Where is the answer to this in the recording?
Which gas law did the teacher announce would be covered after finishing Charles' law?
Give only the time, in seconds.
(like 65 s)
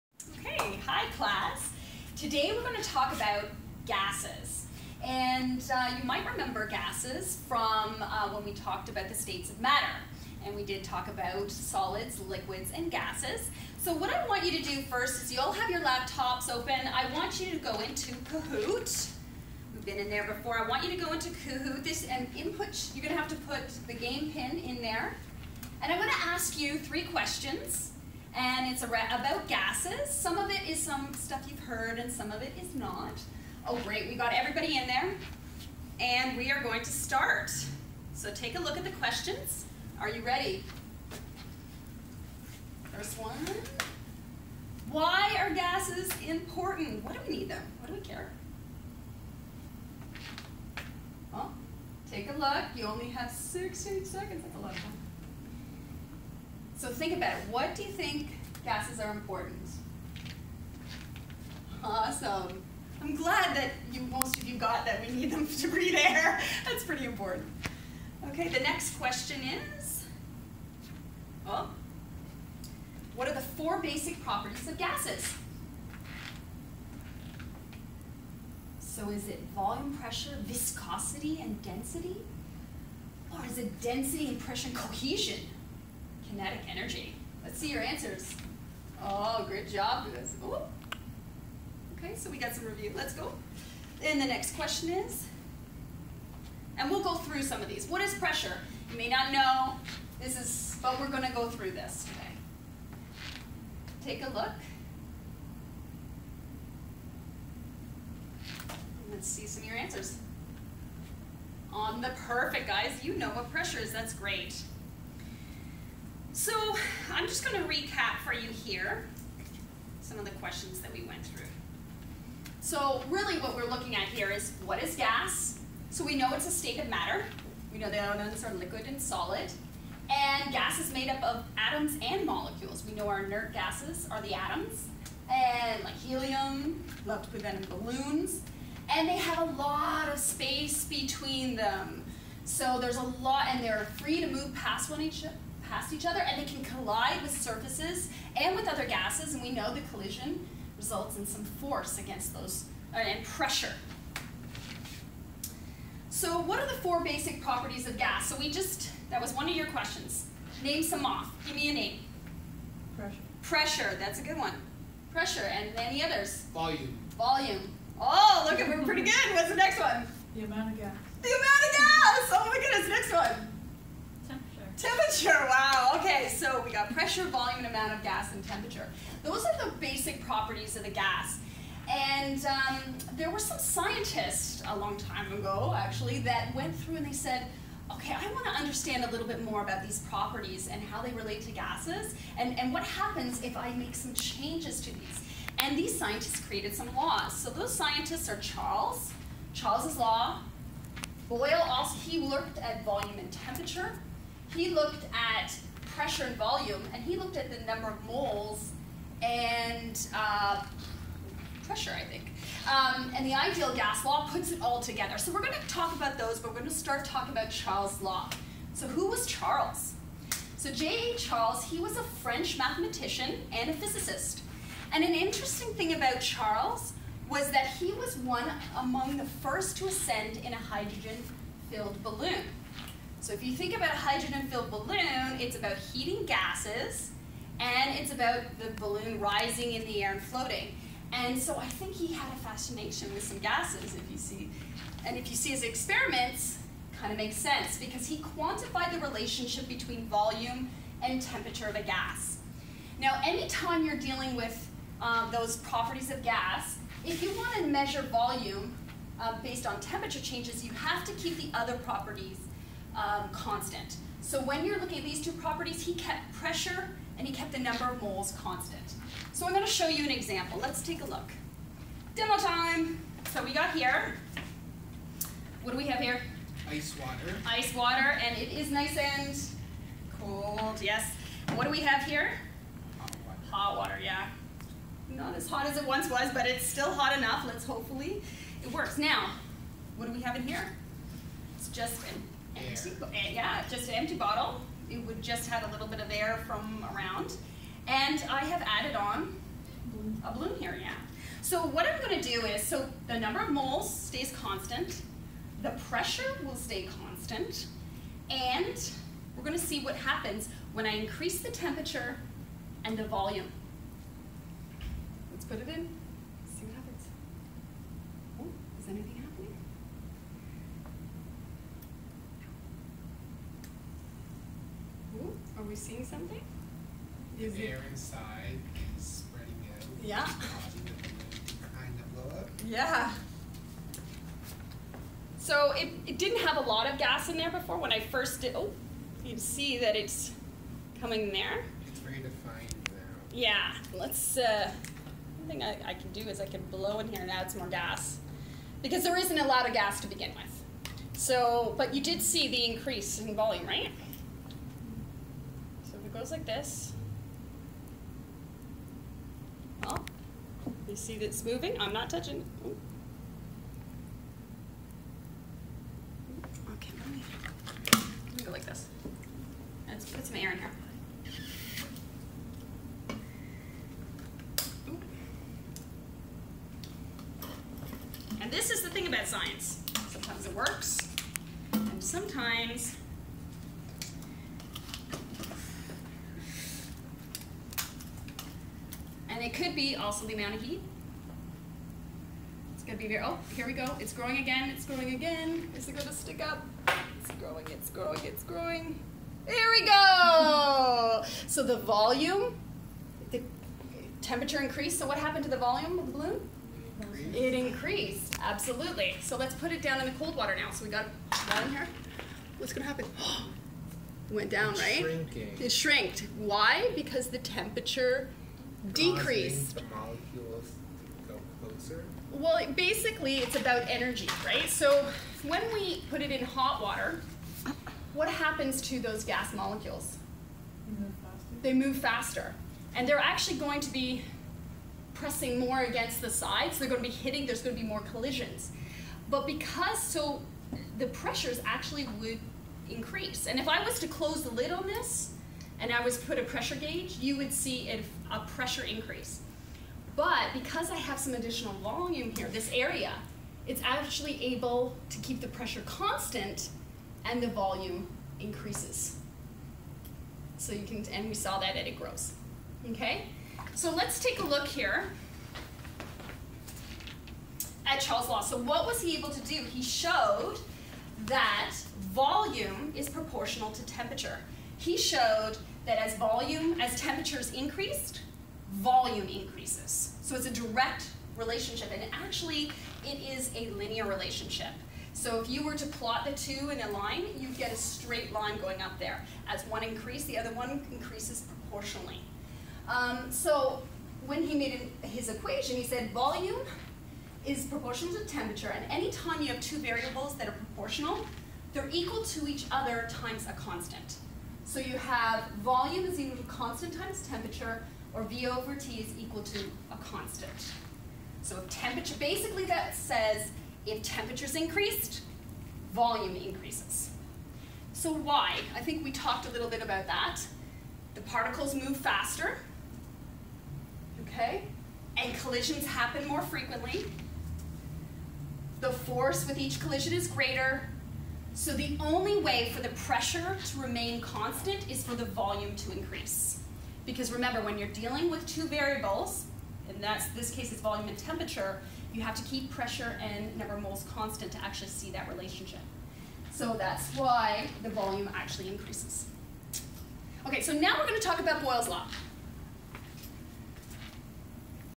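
551 s.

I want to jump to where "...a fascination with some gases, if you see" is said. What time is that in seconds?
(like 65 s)
242 s.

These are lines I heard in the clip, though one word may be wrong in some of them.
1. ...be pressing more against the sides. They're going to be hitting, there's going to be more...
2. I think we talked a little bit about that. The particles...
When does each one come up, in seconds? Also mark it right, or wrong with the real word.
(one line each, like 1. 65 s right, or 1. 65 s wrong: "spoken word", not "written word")
1. 433 s right
2. 518 s right.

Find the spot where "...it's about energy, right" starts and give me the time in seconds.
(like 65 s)
423 s.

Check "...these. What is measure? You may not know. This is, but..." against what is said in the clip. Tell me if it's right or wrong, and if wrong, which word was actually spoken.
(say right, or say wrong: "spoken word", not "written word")
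wrong: "pressure", not "measure".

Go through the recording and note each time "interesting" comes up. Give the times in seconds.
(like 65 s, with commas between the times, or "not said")
225 s.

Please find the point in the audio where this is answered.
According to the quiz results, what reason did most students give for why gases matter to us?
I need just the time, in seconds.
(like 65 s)
65 s.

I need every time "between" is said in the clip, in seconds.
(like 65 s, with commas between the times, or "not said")
140 s, 249 s.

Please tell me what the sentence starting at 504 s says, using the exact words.
So you have volume is equal to constant times temperature, or V over T is equal to a constant.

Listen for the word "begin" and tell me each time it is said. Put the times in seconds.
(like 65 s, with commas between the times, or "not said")
350 s.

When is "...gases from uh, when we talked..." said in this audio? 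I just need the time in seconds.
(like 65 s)
6 s.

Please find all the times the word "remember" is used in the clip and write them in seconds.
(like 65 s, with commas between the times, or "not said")
6 s, 537 s.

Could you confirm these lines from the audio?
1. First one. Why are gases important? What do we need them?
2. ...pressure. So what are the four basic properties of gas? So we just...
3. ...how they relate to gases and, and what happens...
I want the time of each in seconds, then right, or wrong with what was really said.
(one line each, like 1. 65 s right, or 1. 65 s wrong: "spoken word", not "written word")
1. 42 s right
2. 153 s right
3. 190 s right.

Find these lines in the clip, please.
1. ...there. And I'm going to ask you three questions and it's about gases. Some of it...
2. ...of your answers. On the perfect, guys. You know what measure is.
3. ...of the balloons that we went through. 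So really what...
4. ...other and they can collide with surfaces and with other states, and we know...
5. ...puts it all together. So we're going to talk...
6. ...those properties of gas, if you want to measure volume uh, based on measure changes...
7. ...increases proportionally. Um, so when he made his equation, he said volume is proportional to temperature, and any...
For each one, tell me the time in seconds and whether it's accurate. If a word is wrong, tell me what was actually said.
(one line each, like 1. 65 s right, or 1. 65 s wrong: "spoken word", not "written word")
1. 24 s right
2. 109 s wrong: "pressure", not "measure"
3. 120 s wrong: "questions", not "balloons"
4. 146 s wrong: "gases", not "states"
5. 214 s right
6. 255 s wrong: "temperature", not "measure"
7. 490 s right.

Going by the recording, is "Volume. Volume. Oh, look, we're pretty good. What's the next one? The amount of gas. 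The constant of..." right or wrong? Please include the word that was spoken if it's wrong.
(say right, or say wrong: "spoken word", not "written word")
wrong: "amount", not "constant".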